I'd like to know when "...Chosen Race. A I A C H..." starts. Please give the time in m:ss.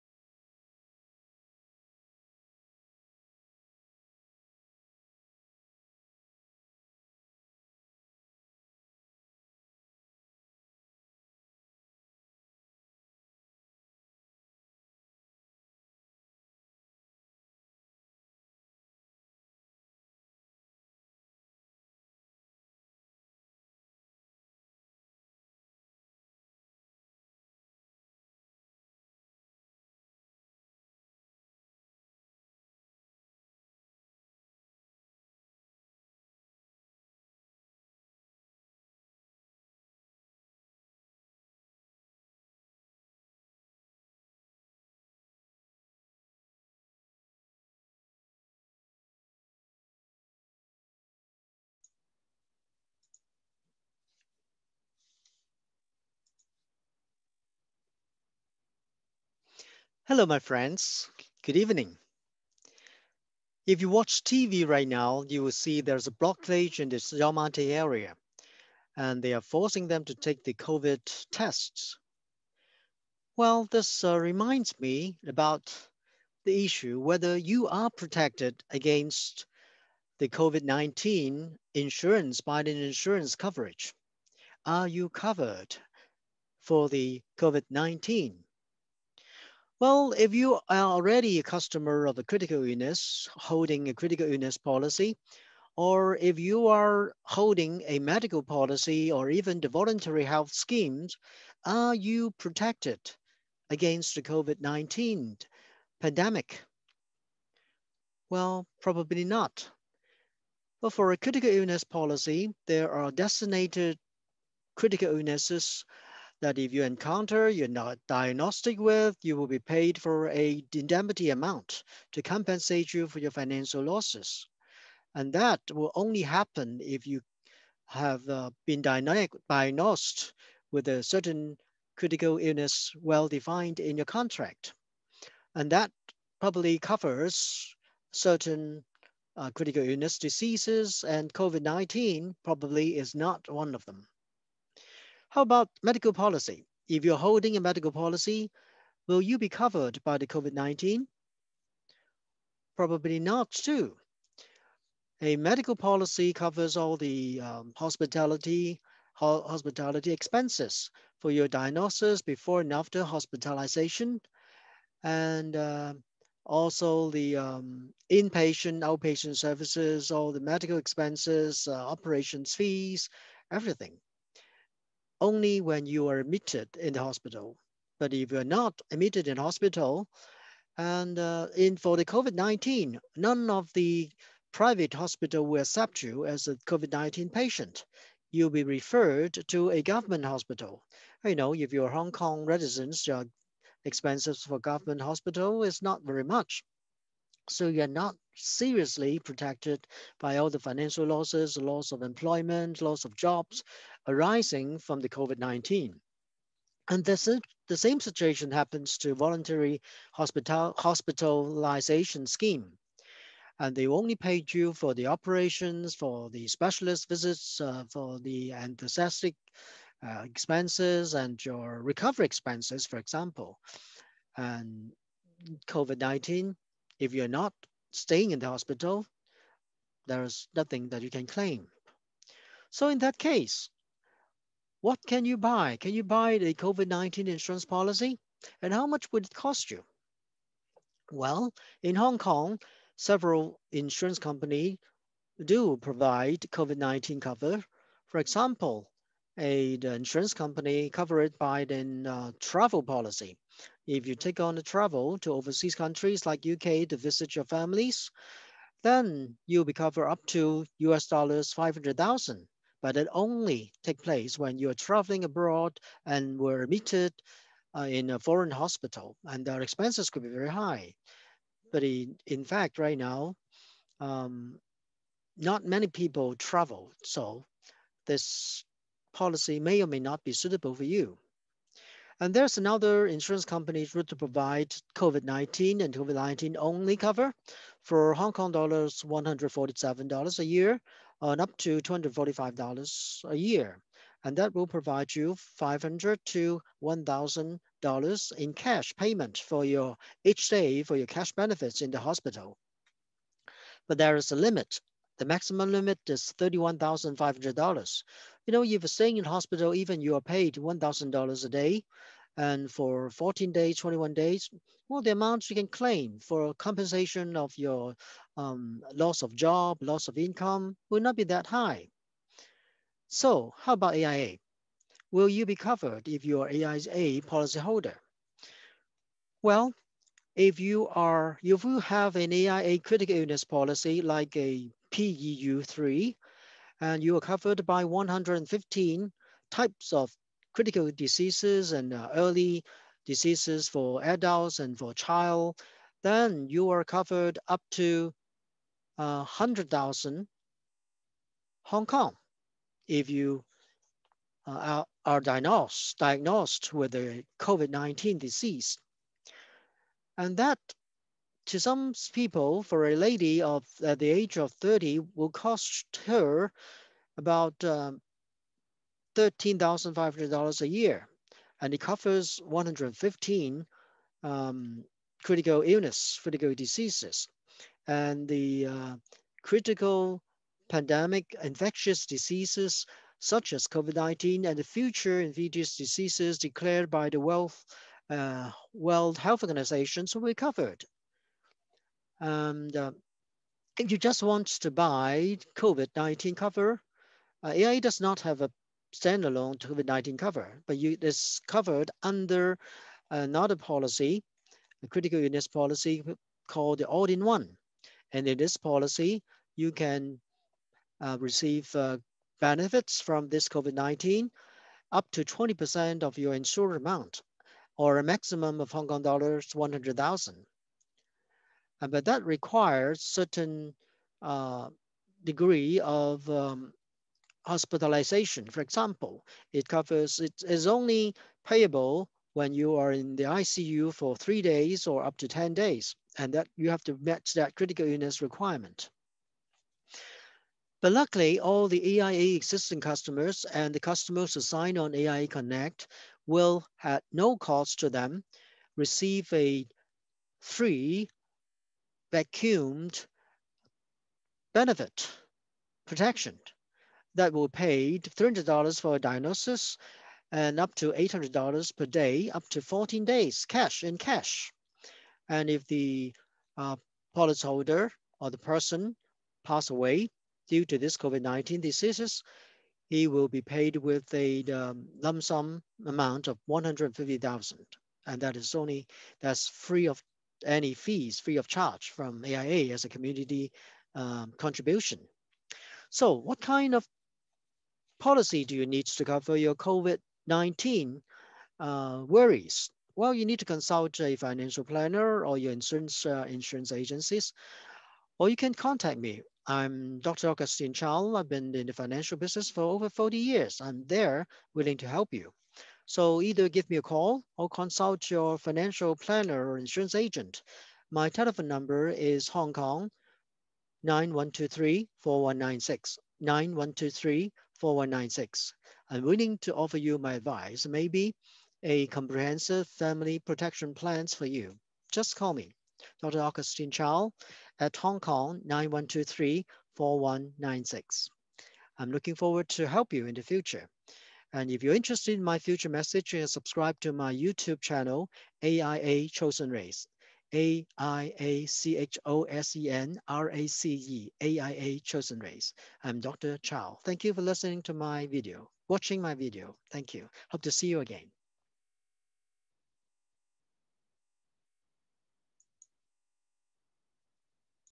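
8:59.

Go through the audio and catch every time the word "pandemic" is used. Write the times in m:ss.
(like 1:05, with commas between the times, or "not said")
1:45, 6:20.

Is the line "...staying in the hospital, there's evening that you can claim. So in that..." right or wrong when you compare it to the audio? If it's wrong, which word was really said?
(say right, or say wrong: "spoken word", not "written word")
wrong: "nothing", not "evening".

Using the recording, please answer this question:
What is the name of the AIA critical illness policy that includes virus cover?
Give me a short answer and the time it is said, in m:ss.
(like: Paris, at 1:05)
all-in-one, at 6:46.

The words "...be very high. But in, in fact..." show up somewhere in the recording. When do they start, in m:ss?
4:30.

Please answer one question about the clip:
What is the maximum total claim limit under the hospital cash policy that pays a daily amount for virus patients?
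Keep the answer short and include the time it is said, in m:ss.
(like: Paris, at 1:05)
$31,500, at 5:06.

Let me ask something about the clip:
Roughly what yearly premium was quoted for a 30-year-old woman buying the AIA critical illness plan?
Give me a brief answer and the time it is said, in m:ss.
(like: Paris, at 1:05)
$13,500, at 6:09.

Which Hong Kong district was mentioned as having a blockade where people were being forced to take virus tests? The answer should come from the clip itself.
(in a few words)
Yau Ma Tei.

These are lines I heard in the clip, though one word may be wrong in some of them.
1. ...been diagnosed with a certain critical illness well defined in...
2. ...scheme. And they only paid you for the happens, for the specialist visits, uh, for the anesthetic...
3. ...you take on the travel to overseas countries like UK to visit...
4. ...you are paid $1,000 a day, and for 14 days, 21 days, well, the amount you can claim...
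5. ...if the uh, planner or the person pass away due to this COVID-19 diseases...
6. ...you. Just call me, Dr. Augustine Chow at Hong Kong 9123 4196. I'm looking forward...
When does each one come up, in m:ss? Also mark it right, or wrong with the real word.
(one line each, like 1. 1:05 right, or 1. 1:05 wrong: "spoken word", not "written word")
1. 2:08 right
2. 3:32 wrong: "operations", not "happens"
3. 4:14 right
4. 5:10 right
5. 7:45 wrong: "policyholder", not "planner"
6. 8:44 right.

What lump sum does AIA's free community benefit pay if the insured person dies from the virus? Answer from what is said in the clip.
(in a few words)
150,000.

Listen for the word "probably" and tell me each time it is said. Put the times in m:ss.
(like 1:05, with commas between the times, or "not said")
1:48, 2:16, 2:22, 2:32.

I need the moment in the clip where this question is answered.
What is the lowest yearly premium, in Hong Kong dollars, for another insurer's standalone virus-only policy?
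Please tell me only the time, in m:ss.
4:49.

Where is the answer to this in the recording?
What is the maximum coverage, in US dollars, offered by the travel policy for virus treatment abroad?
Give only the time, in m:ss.
4:20.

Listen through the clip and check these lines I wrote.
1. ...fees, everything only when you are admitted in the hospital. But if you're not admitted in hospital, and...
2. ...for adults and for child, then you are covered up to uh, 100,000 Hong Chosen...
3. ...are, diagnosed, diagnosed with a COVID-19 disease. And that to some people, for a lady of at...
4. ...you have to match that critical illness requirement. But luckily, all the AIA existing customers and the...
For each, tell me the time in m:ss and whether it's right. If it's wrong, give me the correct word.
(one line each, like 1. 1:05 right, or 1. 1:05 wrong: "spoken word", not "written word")
1. 2:52 right
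2. 5:43 wrong: "Kong", not "Chosen"
3. 5:55 right
4. 7:16 right.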